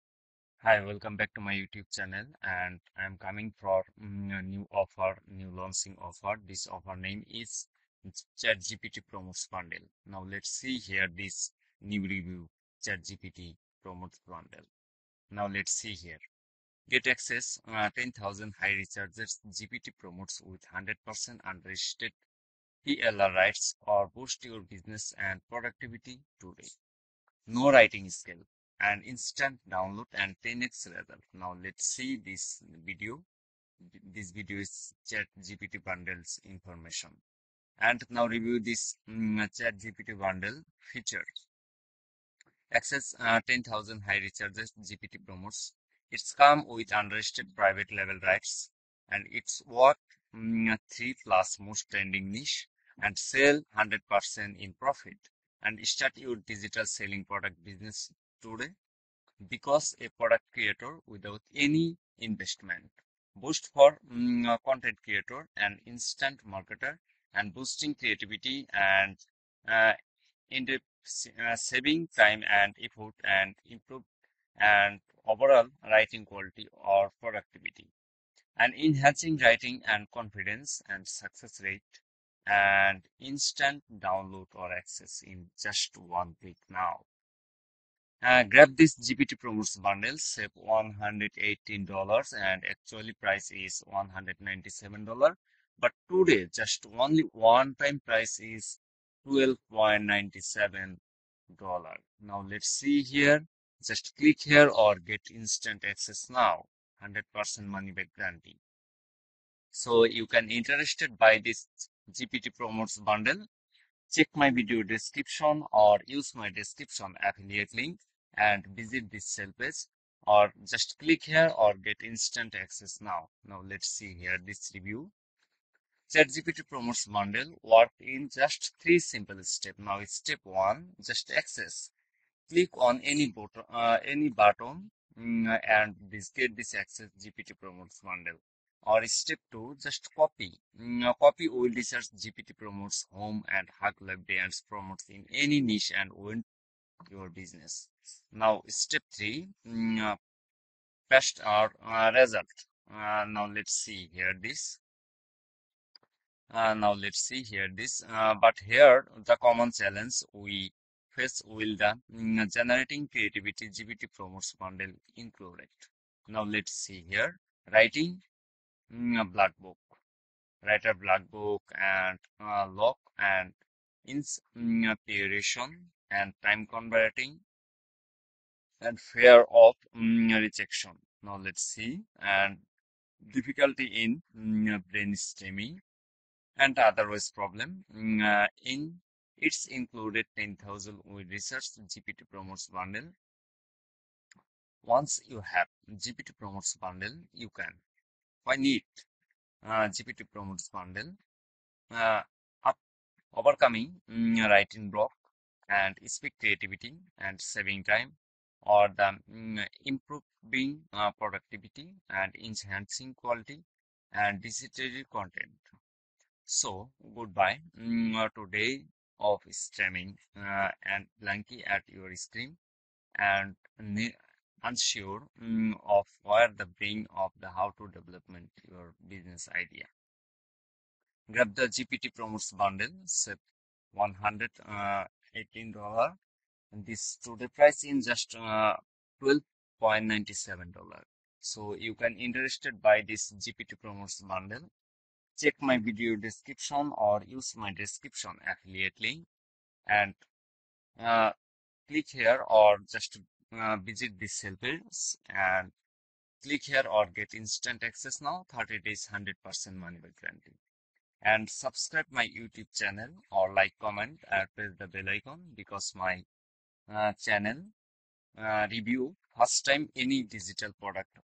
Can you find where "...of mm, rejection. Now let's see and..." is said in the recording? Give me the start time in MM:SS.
02:59.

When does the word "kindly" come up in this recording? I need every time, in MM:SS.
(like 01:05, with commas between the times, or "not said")
not said.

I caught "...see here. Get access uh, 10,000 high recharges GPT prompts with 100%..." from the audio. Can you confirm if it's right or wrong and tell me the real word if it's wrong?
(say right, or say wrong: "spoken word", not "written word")
right.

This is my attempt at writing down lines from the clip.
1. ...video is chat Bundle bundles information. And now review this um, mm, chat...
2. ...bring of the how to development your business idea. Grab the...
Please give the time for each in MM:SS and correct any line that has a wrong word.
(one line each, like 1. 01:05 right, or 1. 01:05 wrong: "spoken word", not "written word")
1. 00:34 wrong: "GPT", not "Bundle"
2. 03:46 right.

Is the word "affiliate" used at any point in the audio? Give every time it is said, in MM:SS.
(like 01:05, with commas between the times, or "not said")
01:57, 04:08.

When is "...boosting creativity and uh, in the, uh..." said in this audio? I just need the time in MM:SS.
01:07.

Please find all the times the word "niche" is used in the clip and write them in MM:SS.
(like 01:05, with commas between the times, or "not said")
00:52, 02:25.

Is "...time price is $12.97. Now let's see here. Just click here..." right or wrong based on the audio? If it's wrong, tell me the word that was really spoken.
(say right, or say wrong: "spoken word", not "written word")
right.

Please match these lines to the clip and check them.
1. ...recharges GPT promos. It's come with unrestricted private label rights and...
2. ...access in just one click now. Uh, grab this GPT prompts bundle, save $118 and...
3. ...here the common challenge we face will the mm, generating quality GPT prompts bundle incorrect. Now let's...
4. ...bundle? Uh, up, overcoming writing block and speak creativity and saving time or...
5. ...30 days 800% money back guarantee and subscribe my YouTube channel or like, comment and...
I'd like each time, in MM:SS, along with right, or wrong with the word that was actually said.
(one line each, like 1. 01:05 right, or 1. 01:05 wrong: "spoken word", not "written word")
1. 00:44 right
2. 01:24 right
3. 02:38 wrong: "creativity", not "quality"
4. 03:20 right
5. 04:18 wrong: "100", not "800".